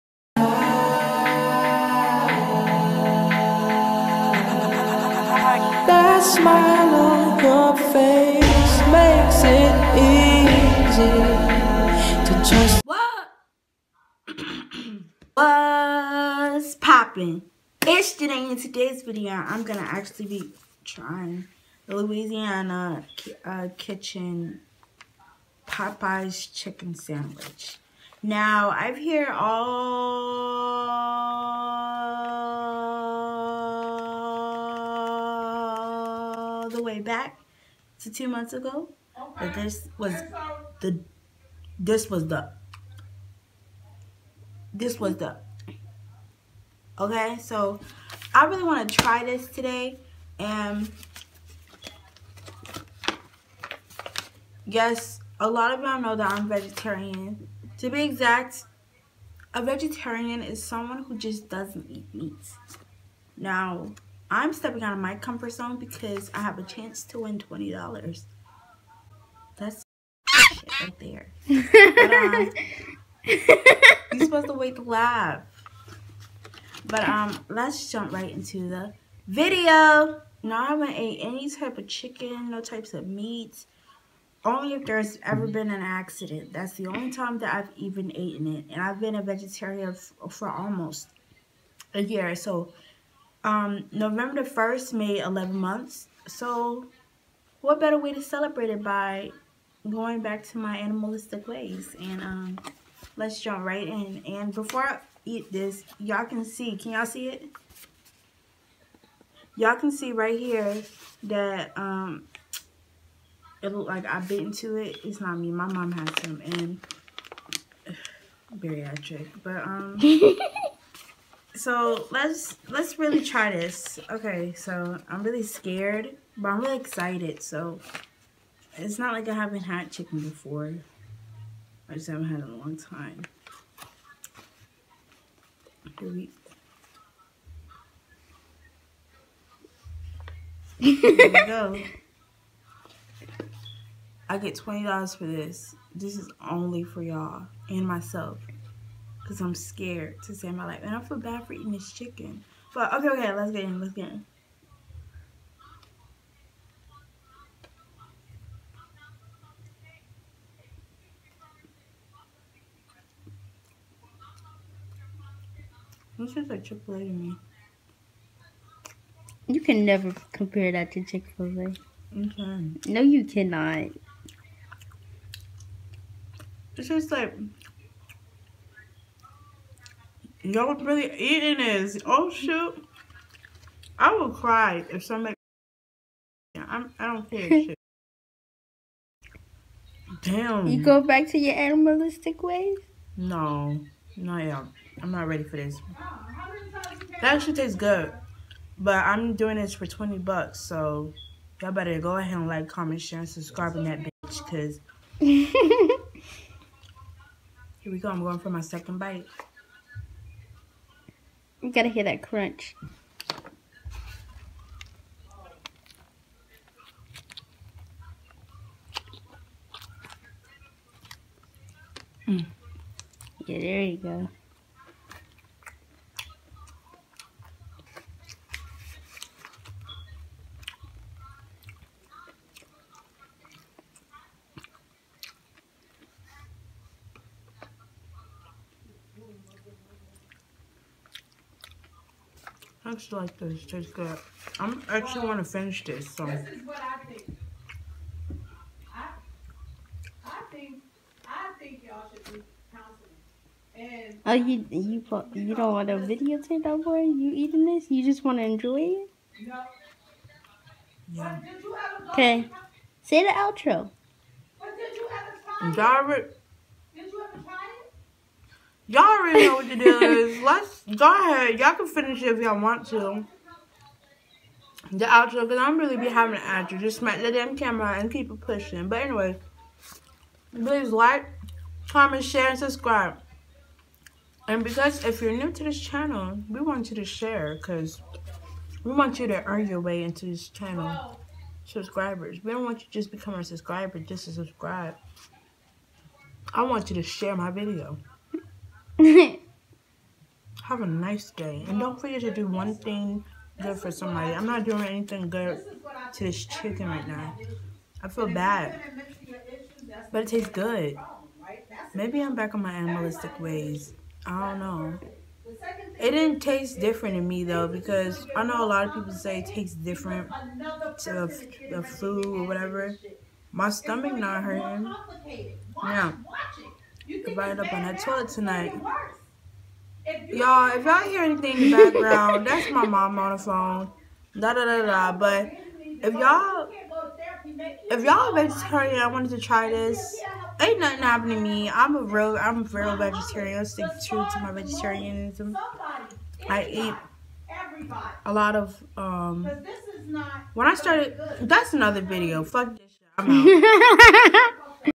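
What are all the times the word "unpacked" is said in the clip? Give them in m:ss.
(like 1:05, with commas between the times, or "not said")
not said.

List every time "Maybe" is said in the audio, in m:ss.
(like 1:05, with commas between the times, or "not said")
5:11.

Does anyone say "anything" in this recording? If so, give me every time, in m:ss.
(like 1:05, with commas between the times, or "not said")
5:04, 5:31.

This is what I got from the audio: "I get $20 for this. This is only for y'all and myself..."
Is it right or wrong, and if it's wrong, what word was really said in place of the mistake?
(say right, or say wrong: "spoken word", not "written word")
right.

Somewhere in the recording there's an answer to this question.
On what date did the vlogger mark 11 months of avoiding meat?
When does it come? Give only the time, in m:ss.
1:33.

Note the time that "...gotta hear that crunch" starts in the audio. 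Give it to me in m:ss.
3:31.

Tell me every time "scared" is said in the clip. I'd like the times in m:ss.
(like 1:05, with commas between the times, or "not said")
2:05, 2:29.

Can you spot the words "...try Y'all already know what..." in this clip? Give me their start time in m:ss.
4:27.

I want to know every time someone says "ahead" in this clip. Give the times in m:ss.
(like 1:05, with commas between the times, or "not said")
3:22, 4:31.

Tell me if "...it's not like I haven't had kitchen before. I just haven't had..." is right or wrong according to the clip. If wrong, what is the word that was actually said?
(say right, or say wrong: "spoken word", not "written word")
wrong: "chicken", not "kitchen".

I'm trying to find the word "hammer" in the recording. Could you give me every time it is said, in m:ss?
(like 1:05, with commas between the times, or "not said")
not said.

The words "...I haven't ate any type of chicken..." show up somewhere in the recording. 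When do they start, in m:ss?
1:20.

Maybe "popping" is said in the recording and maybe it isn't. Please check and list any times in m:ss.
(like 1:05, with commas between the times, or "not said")
0:16.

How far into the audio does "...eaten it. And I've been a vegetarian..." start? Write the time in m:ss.
1:28.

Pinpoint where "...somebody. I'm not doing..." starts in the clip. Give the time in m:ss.
5:03.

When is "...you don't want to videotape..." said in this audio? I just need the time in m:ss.
4:15.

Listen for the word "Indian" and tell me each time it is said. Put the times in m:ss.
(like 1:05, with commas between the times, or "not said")
not said.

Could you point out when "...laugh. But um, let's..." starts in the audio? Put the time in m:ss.
1:14.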